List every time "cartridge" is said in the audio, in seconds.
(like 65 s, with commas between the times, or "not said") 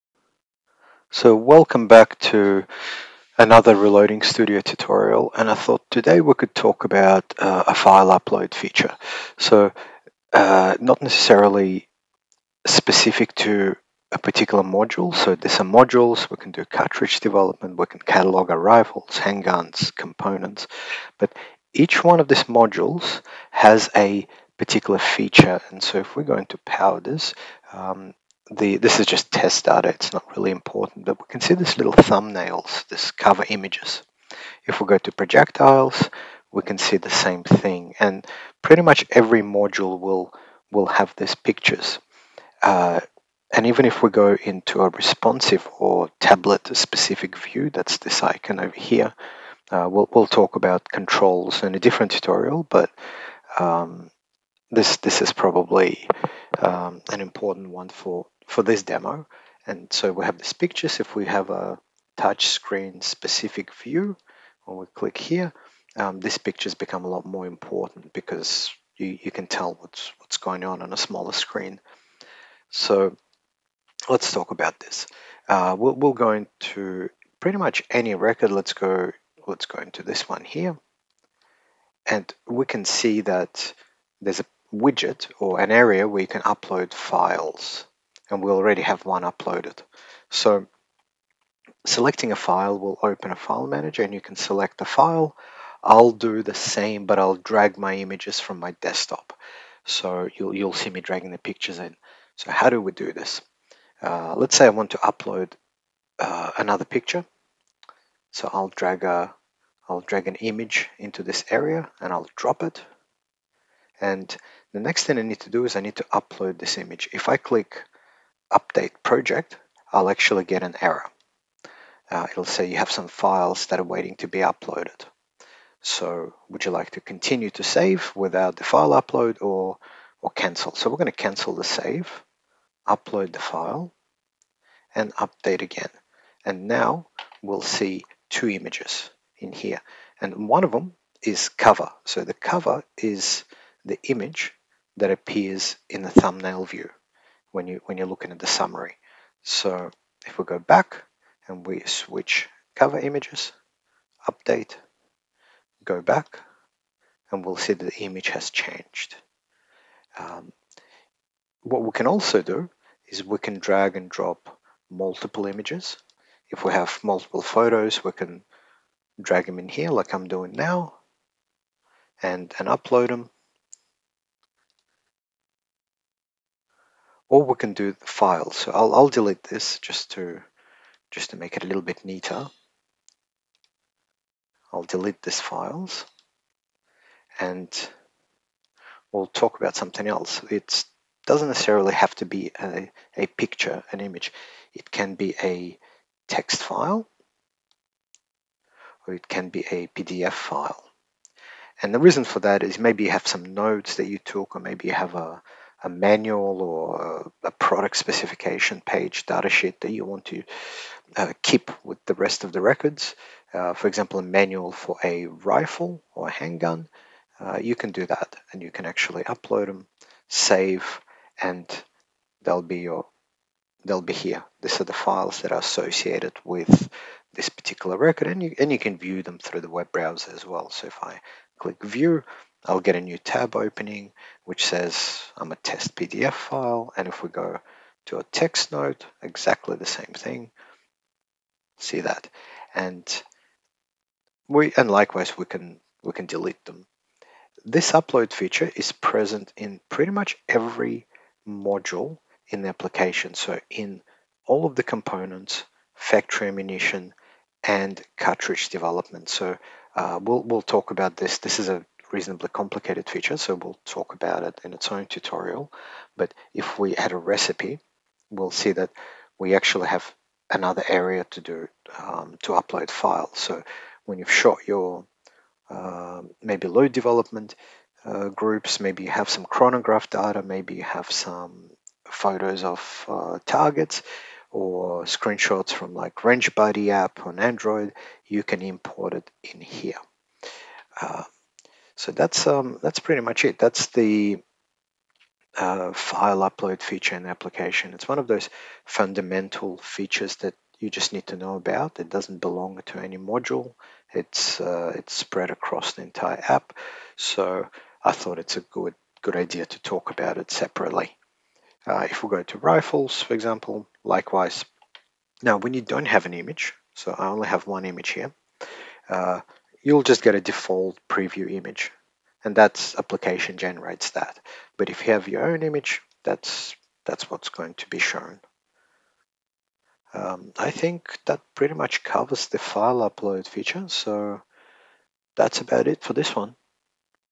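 16 s, 258 s.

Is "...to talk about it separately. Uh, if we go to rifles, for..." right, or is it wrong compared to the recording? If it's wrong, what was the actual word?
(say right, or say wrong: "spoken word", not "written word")
right.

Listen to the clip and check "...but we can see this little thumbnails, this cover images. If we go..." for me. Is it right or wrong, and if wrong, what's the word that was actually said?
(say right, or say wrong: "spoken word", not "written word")
right.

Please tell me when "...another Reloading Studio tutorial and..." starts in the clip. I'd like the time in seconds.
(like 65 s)
3 s.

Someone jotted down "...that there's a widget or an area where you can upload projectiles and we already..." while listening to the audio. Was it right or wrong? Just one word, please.
wrong.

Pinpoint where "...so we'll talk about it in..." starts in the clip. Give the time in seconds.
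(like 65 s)
263 s.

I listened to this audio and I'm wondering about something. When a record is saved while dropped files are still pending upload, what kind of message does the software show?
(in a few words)
An error.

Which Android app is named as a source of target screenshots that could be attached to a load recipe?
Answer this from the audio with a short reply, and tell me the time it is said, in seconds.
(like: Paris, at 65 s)
Range Buddy, at 286 s.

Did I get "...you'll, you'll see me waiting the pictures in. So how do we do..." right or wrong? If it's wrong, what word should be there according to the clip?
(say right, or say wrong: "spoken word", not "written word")
wrong: "dragging", not "waiting".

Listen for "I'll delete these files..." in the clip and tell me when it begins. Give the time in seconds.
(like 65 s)
184 s.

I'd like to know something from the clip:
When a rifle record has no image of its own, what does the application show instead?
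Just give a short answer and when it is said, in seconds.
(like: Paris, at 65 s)
A default preview image, at 320 s.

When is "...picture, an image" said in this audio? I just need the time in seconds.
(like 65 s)
193 s.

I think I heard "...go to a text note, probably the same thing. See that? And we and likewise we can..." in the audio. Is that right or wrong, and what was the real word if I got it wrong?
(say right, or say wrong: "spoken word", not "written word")
wrong: "exactly", not "probably".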